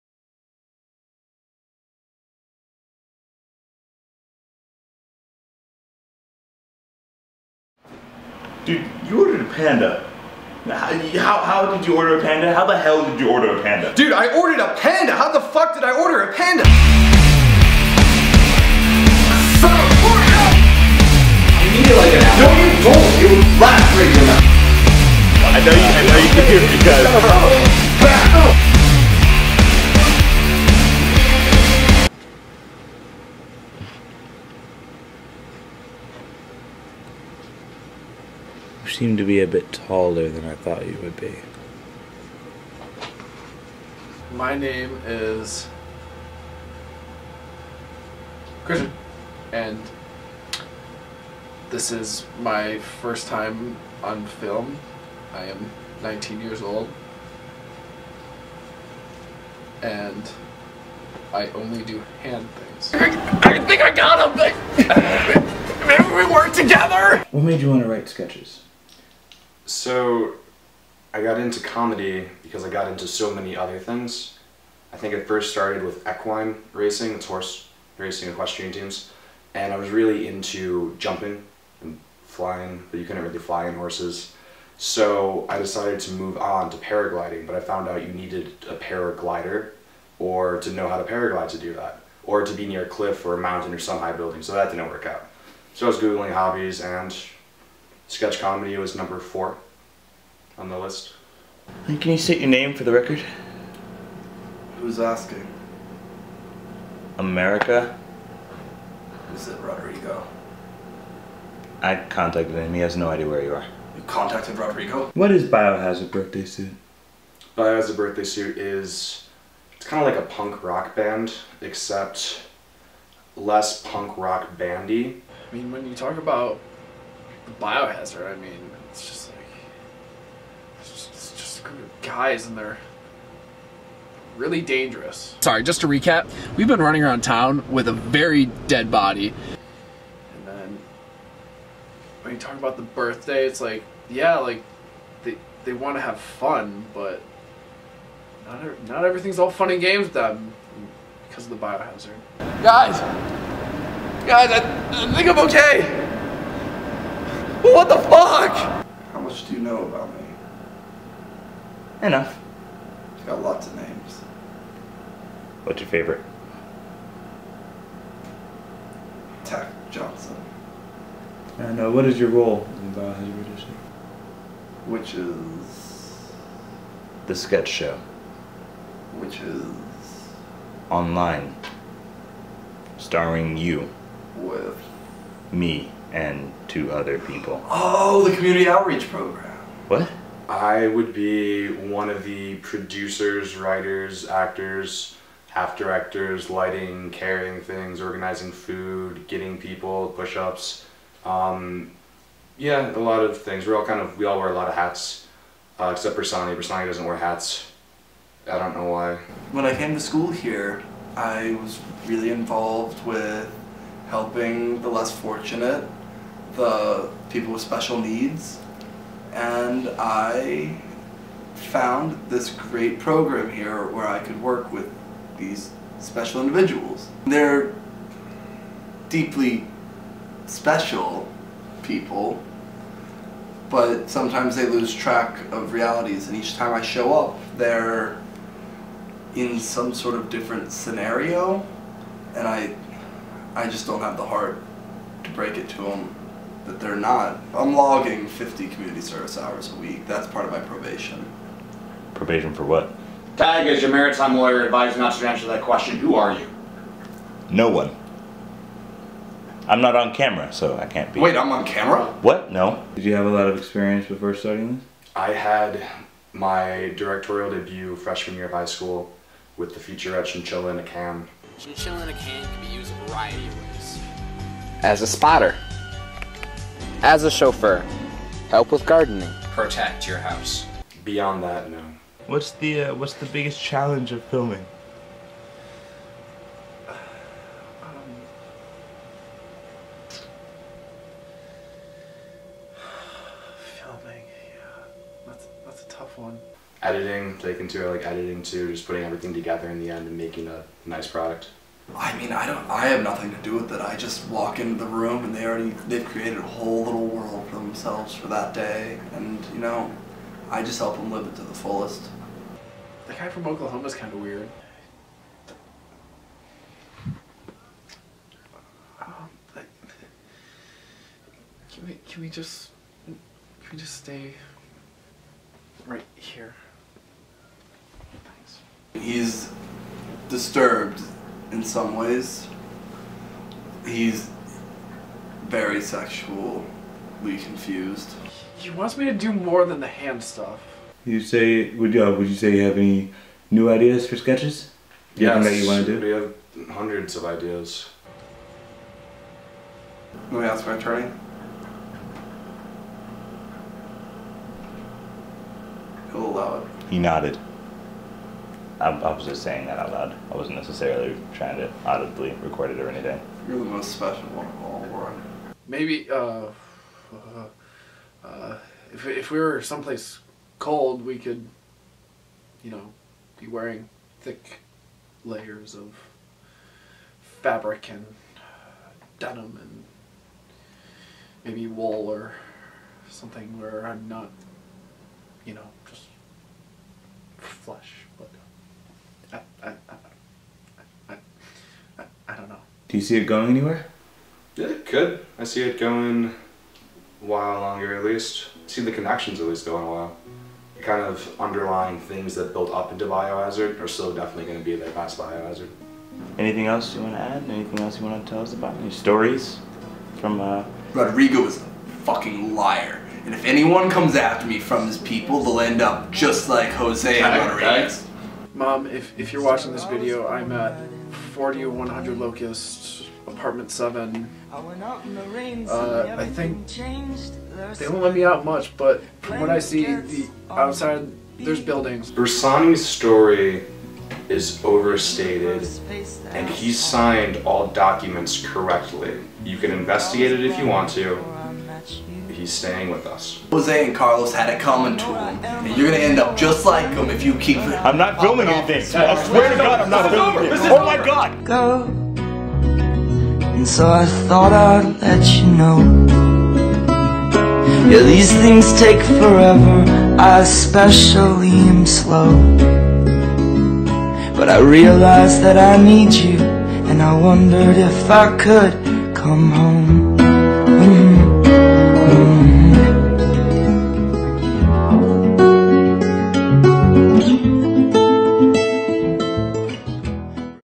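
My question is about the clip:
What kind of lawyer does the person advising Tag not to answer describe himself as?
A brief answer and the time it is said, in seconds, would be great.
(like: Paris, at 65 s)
Maritime lawyer, at 253 s.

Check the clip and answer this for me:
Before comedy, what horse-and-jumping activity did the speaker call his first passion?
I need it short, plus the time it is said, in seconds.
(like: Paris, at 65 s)
Equine racing, at 76 s.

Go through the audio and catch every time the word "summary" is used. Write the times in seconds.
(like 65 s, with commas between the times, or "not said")
not said.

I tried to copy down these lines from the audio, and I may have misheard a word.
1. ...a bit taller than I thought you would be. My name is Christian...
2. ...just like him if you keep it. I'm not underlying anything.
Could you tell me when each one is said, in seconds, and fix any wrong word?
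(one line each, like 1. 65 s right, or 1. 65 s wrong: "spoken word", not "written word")
1. 39 s right
2. 446 s wrong: "filming", not "underlying".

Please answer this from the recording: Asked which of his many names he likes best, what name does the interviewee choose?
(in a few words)
Tack Johnson.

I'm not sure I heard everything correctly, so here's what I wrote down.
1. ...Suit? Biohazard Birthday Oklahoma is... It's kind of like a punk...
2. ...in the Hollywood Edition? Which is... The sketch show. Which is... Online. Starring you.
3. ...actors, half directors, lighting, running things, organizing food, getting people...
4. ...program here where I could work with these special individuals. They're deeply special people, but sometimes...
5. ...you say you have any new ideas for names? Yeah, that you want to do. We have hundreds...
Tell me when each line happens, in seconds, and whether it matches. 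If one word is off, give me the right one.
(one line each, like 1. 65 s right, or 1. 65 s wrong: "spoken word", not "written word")
1. 116 s wrong: "Suit", not "Oklahoma"
2. 172 s right
3. 194 s wrong: "carrying", not "running"
4. 222 s right
5. 342 s wrong: "sketches", not "names".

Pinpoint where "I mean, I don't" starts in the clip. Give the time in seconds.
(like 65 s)
301 s.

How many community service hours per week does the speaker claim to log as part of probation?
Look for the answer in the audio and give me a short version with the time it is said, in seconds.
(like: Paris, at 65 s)
50, at 248 s.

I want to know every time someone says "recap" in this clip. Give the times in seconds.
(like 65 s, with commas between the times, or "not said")
135 s.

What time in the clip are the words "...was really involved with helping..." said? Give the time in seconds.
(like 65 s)
211 s.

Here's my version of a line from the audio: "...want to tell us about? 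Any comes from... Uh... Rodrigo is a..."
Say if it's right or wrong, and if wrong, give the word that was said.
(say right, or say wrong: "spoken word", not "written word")
wrong: "stories", not "comes".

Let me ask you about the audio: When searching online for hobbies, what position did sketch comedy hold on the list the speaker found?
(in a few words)
4.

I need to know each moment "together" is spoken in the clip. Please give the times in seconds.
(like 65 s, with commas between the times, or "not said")
66 s, 299 s.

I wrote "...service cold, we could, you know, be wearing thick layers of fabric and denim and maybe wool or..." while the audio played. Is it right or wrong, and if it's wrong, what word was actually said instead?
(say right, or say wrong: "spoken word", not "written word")
wrong: "someplace", not "service".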